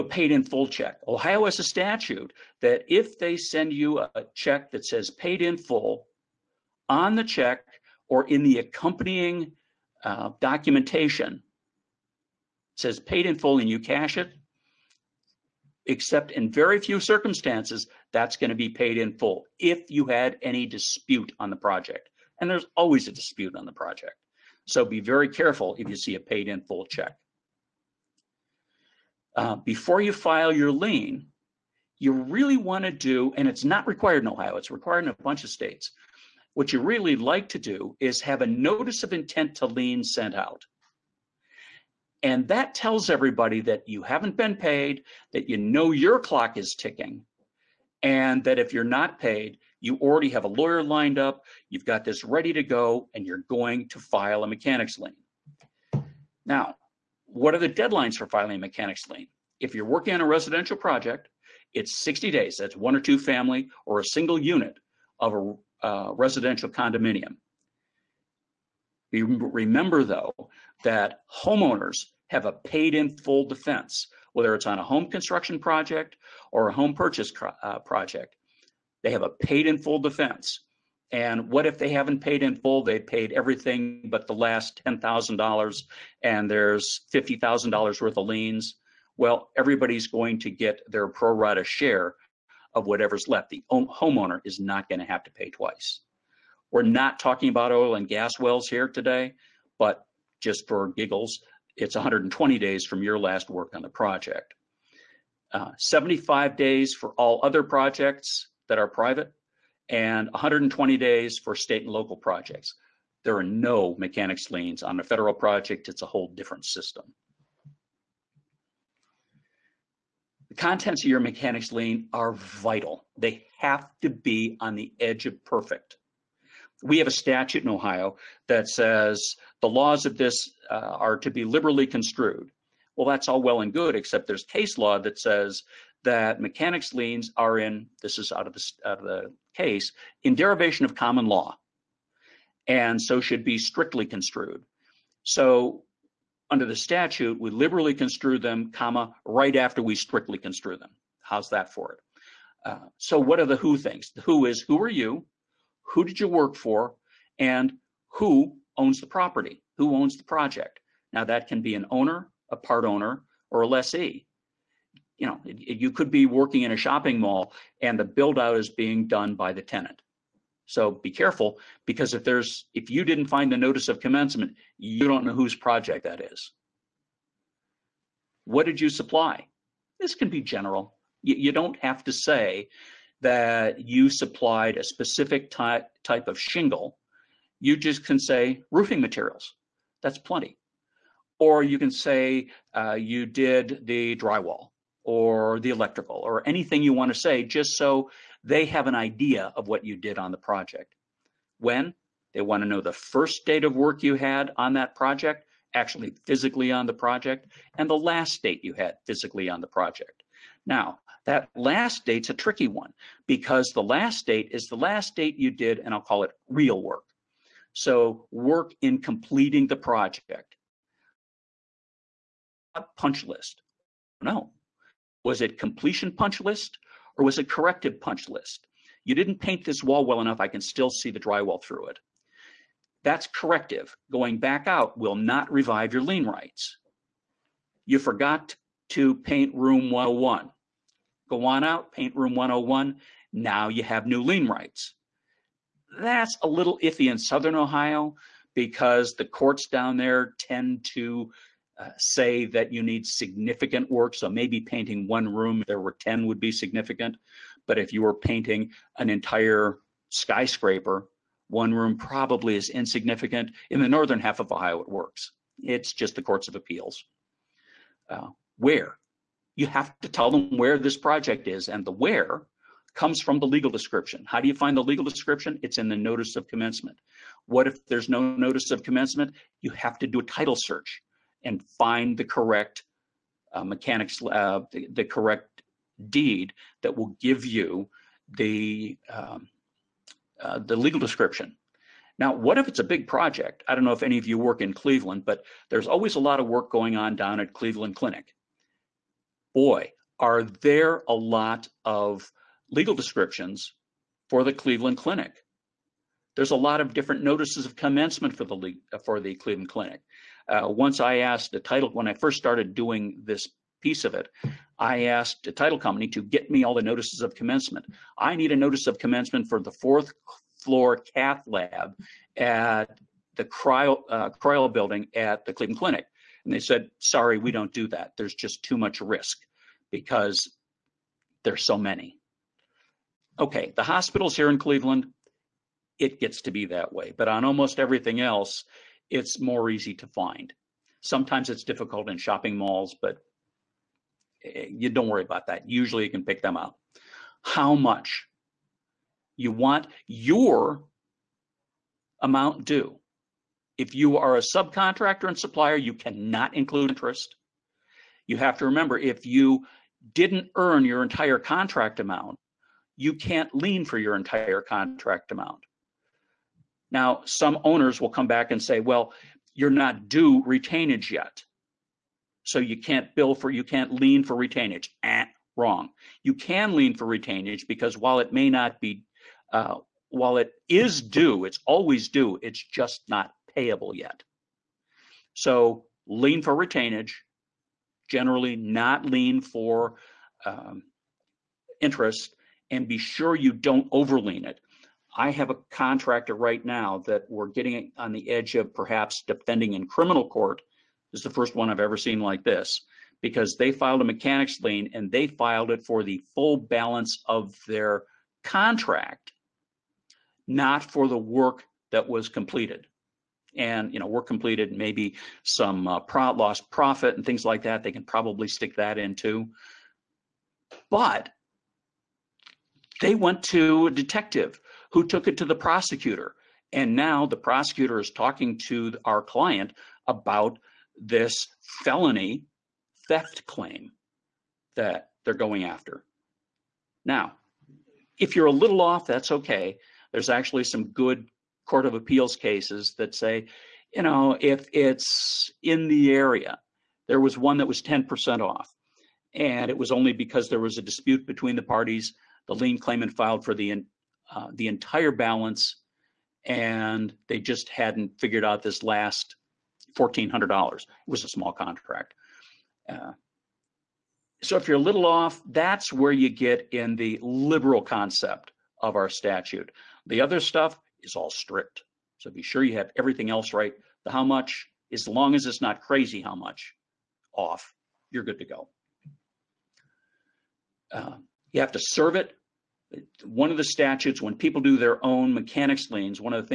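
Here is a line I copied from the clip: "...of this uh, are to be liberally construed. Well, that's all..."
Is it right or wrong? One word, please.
right.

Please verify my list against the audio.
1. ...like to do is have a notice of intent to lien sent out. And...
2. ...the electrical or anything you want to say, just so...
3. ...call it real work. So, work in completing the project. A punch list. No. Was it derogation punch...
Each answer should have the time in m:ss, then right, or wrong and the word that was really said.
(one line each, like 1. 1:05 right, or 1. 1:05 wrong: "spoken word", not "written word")
1. 0:37 right
2. 3:15 right
3. 3:35 wrong: "completion", not "derogation".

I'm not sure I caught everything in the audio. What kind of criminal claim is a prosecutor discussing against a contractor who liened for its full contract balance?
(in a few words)
felony theft.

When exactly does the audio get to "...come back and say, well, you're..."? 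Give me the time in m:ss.
6:08.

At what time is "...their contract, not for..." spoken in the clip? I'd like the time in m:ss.
6:47.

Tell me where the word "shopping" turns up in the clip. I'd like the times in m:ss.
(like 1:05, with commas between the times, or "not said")
2:46, 5:42.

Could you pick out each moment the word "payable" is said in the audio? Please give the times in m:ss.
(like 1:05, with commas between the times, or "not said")
6:23.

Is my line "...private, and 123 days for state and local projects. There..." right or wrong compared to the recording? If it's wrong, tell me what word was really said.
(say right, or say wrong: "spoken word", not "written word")
wrong: "120", not "123".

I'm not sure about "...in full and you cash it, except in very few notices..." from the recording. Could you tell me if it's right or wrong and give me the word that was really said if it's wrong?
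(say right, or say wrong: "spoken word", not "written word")
wrong: "circumstances", not "notices".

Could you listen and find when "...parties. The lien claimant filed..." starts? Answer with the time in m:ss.
7:31.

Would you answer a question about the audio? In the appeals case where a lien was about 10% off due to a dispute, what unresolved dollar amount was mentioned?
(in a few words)
$1,400.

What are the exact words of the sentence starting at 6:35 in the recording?
I have a contractor right now that we're getting on the edge of perhaps defending in criminal court.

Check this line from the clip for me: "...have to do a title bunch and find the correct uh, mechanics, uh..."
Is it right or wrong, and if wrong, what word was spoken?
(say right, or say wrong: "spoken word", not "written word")
wrong: "search", not "bunch".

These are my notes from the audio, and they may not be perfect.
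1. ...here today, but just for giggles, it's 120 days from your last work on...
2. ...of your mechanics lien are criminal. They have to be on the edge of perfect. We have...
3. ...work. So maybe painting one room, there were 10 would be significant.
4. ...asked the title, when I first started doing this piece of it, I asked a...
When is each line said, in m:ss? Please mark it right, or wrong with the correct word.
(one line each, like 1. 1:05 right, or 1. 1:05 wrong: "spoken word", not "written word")
1. 1:38 right
2. 2:01 wrong: "vital", not "criminal"
3. 4:13 right
4. 5:11 right.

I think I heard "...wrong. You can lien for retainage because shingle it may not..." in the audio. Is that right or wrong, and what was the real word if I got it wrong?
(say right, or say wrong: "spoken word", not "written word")
wrong: "while", not "shingle".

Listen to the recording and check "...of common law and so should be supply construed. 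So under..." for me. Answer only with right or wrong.
wrong.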